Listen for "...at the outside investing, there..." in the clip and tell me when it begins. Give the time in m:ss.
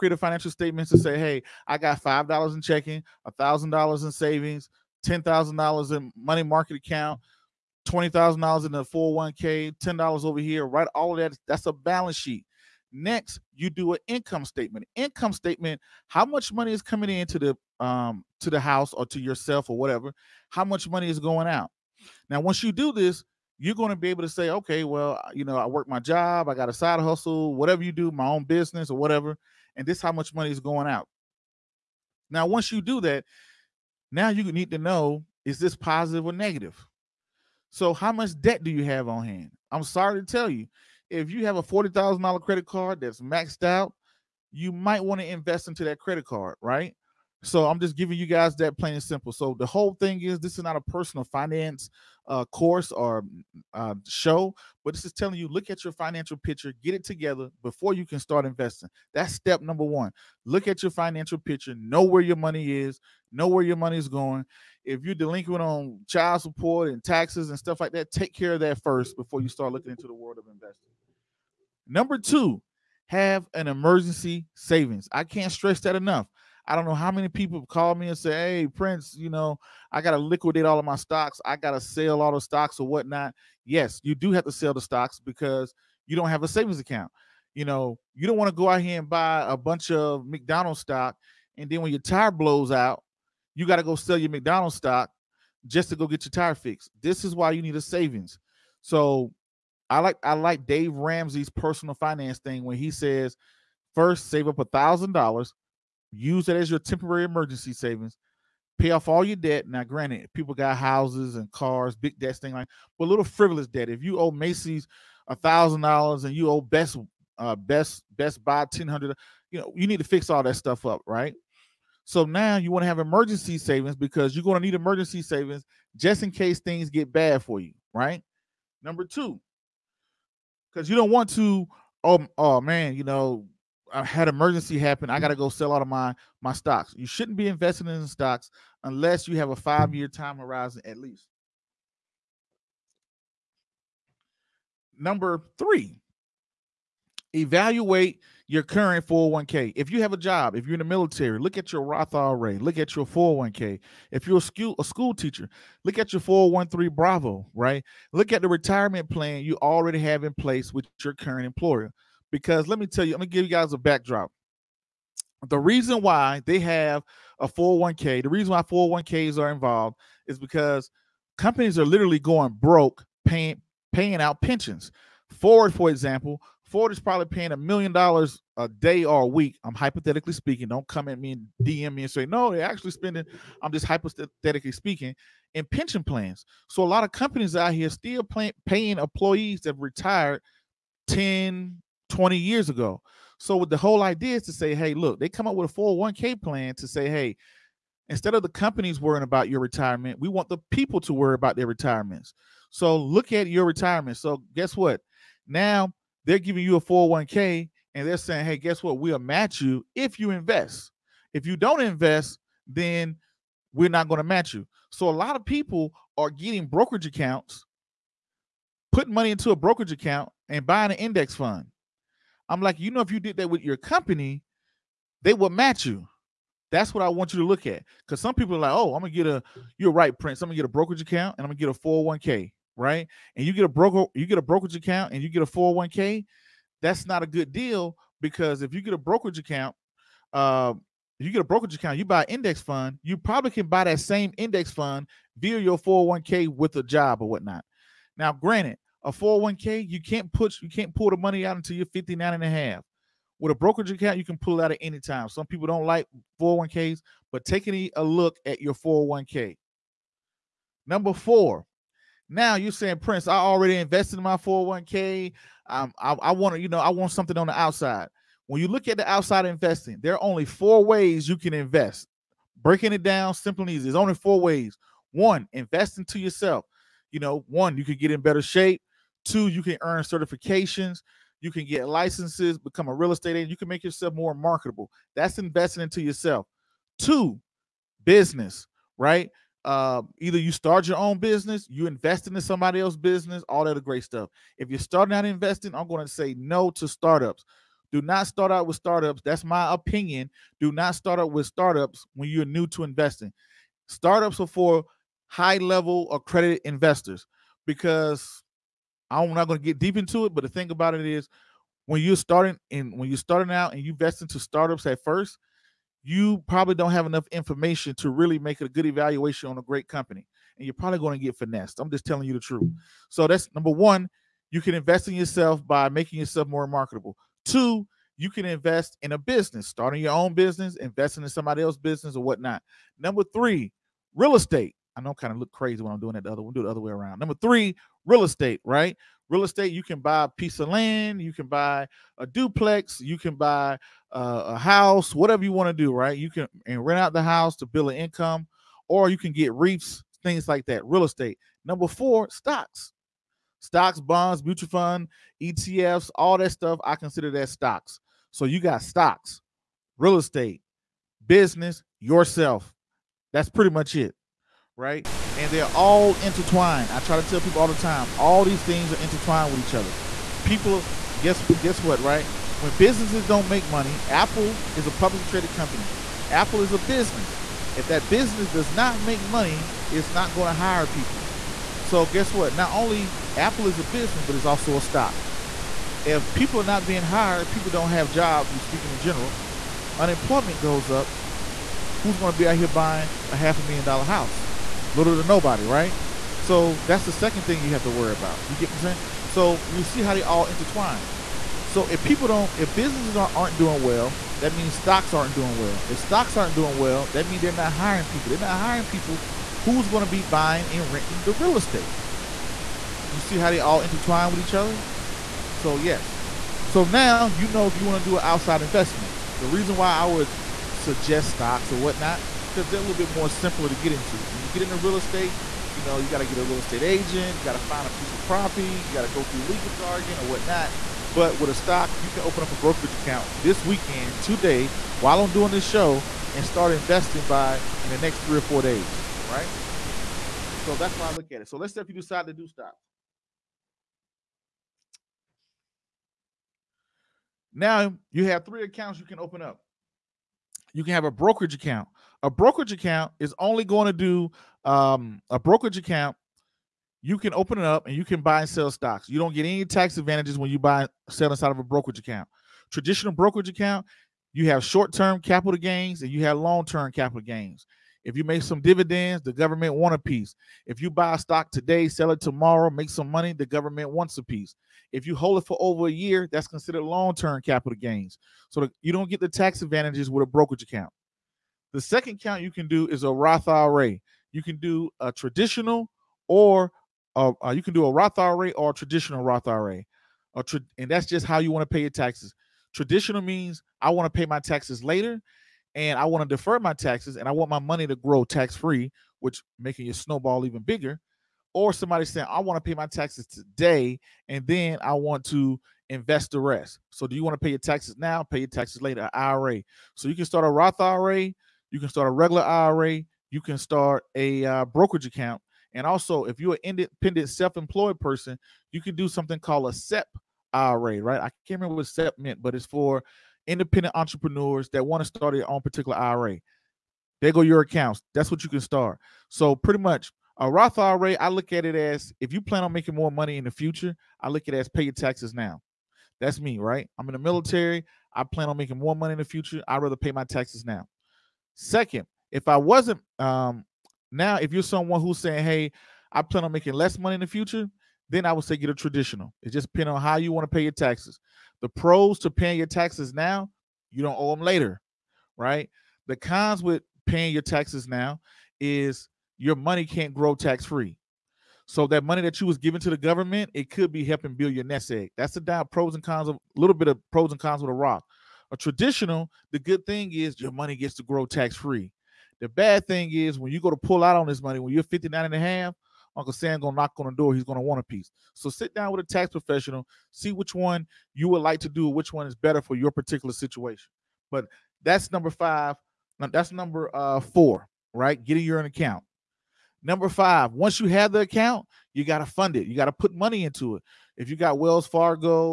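4:28.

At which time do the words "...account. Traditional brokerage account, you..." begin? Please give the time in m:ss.
7:41.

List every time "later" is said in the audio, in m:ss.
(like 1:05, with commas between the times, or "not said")
8:14, 8:28, 9:14.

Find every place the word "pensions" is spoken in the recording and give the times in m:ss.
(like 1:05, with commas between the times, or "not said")
2:54, 3:05.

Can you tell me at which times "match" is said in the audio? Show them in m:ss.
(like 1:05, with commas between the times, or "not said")
3:29, 3:34, 3:45.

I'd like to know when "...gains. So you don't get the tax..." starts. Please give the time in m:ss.
7:57.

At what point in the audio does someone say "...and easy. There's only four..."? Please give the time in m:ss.
4:33.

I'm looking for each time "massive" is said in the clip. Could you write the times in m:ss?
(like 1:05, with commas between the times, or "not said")
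not said.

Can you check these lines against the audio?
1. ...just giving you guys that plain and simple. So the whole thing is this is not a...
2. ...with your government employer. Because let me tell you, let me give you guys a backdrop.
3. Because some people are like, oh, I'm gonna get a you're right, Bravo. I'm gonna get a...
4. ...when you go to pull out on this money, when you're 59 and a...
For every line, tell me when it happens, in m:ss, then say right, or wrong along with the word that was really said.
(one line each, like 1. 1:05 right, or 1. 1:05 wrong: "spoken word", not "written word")
1. 0:47 right
2. 2:40 wrong: "current", not "government"
3. 3:48 wrong: "Prince", not "Bravo"
4. 9:33 right.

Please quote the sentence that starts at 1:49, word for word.
Now, granted, people got houses and cars, big debts, thing like, but little frivolous debt.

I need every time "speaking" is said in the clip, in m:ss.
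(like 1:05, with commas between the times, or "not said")
3:00, 3:04, 6:28.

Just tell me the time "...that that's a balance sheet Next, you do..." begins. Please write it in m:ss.
0:11.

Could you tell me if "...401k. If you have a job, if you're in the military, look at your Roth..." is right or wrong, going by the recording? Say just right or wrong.
right.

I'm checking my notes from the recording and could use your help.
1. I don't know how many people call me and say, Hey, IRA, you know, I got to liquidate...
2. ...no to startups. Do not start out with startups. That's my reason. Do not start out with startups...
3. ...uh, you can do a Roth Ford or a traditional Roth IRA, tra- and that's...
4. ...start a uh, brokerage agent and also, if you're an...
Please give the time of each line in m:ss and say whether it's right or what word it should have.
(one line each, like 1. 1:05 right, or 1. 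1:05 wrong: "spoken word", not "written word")
1. 1:16 wrong: "Prince", not "IRA"
2. 4:56 wrong: "opinion", not "reason"
3. 8:07 wrong: "IRA", not "Ford"
4. 8:33 wrong: "account", not "agent".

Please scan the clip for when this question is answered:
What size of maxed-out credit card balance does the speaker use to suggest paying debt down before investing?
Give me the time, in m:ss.
0:41.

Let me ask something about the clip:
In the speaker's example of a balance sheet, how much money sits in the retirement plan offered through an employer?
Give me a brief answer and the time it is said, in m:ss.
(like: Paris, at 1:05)
$20,000, at 0:07.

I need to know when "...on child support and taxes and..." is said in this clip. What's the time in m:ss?
1:05.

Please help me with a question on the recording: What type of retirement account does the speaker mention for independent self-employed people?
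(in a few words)
SEP IRA.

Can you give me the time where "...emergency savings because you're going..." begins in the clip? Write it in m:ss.
2:02.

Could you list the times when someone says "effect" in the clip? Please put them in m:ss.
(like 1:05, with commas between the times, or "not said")
not said.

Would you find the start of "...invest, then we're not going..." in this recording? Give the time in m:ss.
3:31.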